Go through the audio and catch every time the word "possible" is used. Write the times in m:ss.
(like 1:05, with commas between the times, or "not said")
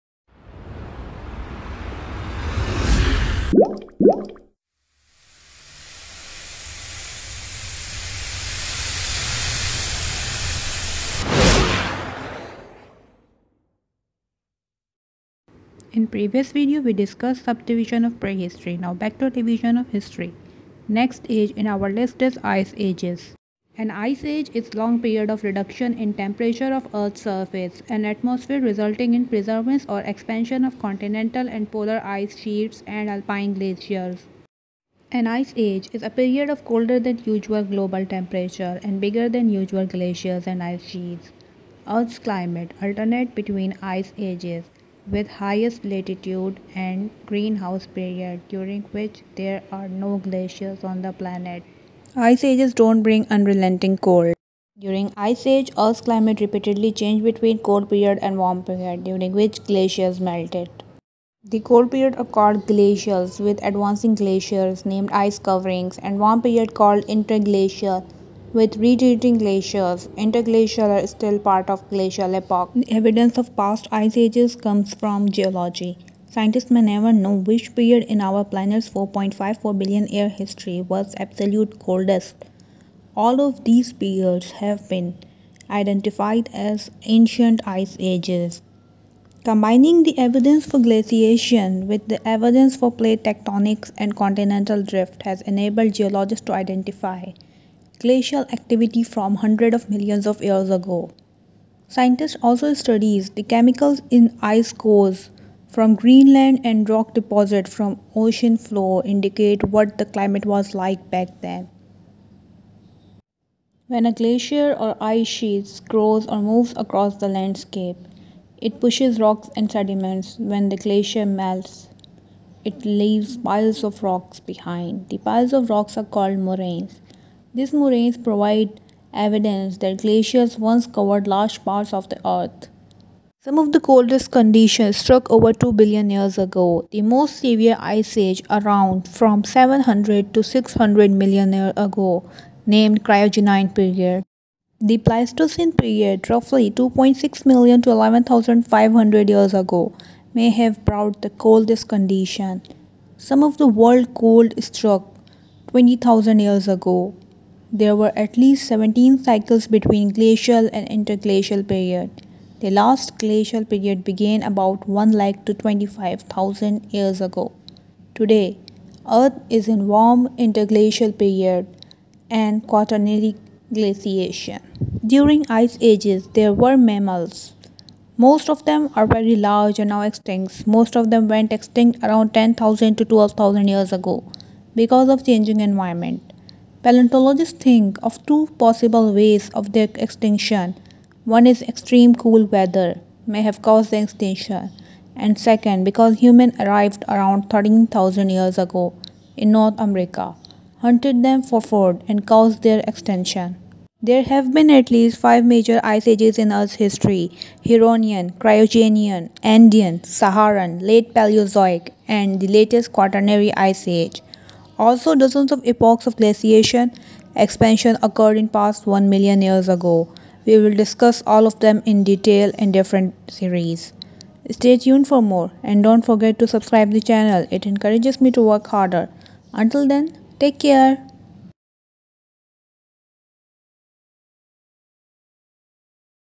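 3:08.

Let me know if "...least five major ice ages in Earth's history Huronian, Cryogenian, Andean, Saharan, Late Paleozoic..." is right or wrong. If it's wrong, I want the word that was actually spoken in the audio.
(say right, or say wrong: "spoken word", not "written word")
right.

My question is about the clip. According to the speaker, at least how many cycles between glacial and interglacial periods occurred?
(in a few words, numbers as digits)
17.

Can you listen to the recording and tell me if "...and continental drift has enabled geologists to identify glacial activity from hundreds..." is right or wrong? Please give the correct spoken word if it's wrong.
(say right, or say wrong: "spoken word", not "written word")
right.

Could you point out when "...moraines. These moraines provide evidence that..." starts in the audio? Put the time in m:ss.
2:06.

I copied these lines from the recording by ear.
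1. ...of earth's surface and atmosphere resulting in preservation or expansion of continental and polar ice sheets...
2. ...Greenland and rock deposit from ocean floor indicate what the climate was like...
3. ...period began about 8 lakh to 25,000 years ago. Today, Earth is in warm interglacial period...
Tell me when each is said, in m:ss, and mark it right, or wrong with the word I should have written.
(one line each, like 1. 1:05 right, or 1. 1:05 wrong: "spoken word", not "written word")
1. 0:26 right
2. 1:45 right
3. 2:43 wrong: "1", not "8".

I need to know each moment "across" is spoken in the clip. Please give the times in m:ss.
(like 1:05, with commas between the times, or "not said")
1:56.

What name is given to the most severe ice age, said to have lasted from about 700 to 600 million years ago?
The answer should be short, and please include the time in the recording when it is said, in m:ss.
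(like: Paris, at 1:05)
Cryogenian period, at 2:23.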